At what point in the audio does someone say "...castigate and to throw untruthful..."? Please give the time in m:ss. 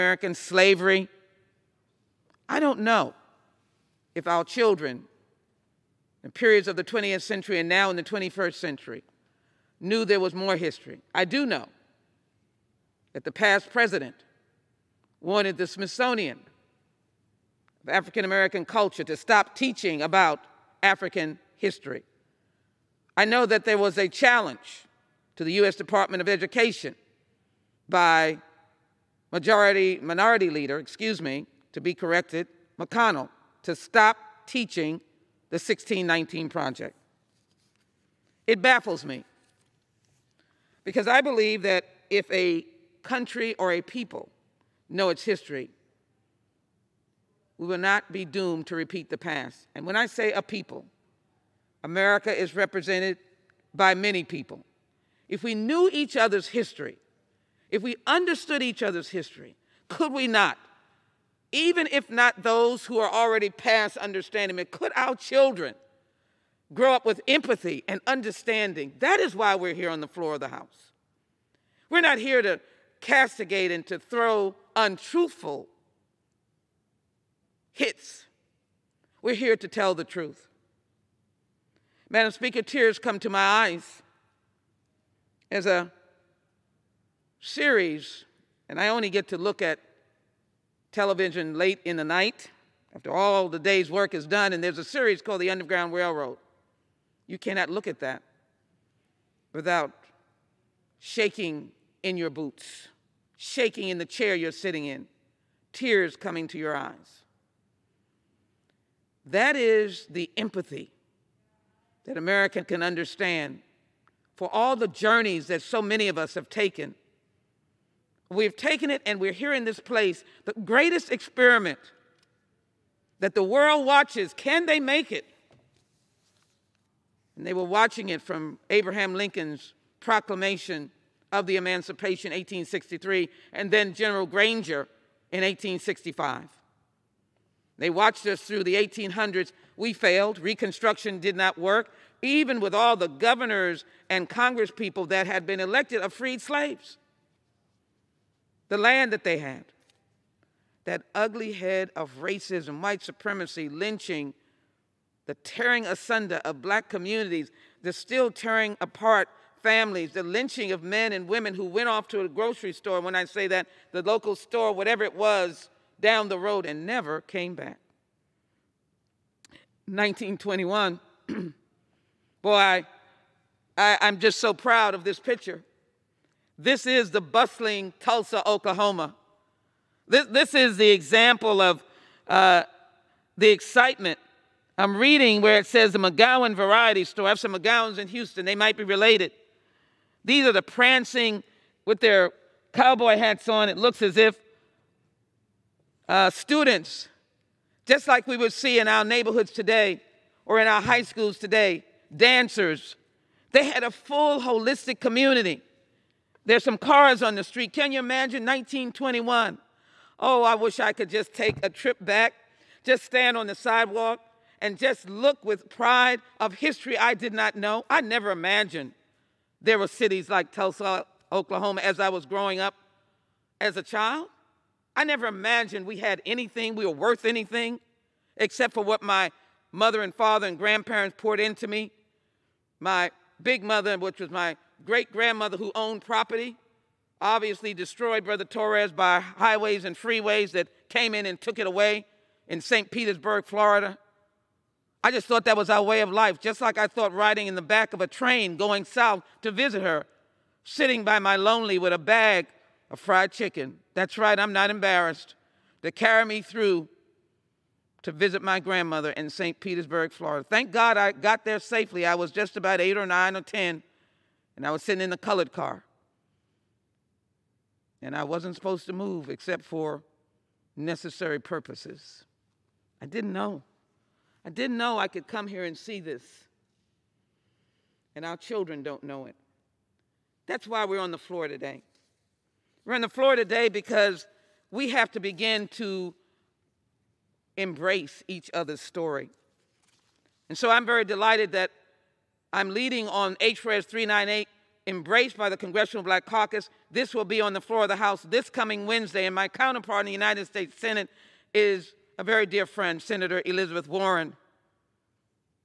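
1:13.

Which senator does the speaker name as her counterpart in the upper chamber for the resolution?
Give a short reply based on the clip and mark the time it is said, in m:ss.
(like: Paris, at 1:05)
Elizabeth Warren, at 5:03.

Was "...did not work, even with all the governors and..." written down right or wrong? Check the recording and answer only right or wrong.
right.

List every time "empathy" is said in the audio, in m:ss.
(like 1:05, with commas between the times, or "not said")
1:07, 1:50.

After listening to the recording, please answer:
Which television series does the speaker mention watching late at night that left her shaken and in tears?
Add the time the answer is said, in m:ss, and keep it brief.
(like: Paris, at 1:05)
The Underground Railroad, at 1:35.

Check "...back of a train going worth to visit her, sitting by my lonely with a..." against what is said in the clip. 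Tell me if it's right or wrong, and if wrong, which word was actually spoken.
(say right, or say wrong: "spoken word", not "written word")
wrong: "south", not "worth".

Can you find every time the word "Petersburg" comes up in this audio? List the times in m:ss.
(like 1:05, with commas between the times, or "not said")
4:02, 4:19.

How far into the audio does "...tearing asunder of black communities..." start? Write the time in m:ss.
2:35.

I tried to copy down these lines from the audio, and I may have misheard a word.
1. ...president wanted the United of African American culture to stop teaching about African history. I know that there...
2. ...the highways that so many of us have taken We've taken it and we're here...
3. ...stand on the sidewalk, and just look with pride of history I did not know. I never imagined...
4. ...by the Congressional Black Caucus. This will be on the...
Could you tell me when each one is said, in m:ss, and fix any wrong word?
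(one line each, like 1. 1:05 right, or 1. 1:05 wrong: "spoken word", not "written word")
1. 0:13 wrong: "Smithsonian", not "United"
2. 1:54 wrong: "journeys", not "highways"
3. 3:33 right
4. 4:55 right.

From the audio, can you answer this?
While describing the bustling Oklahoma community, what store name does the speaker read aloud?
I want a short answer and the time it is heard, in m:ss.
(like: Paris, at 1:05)
McGowan Variety Store, at 3:05.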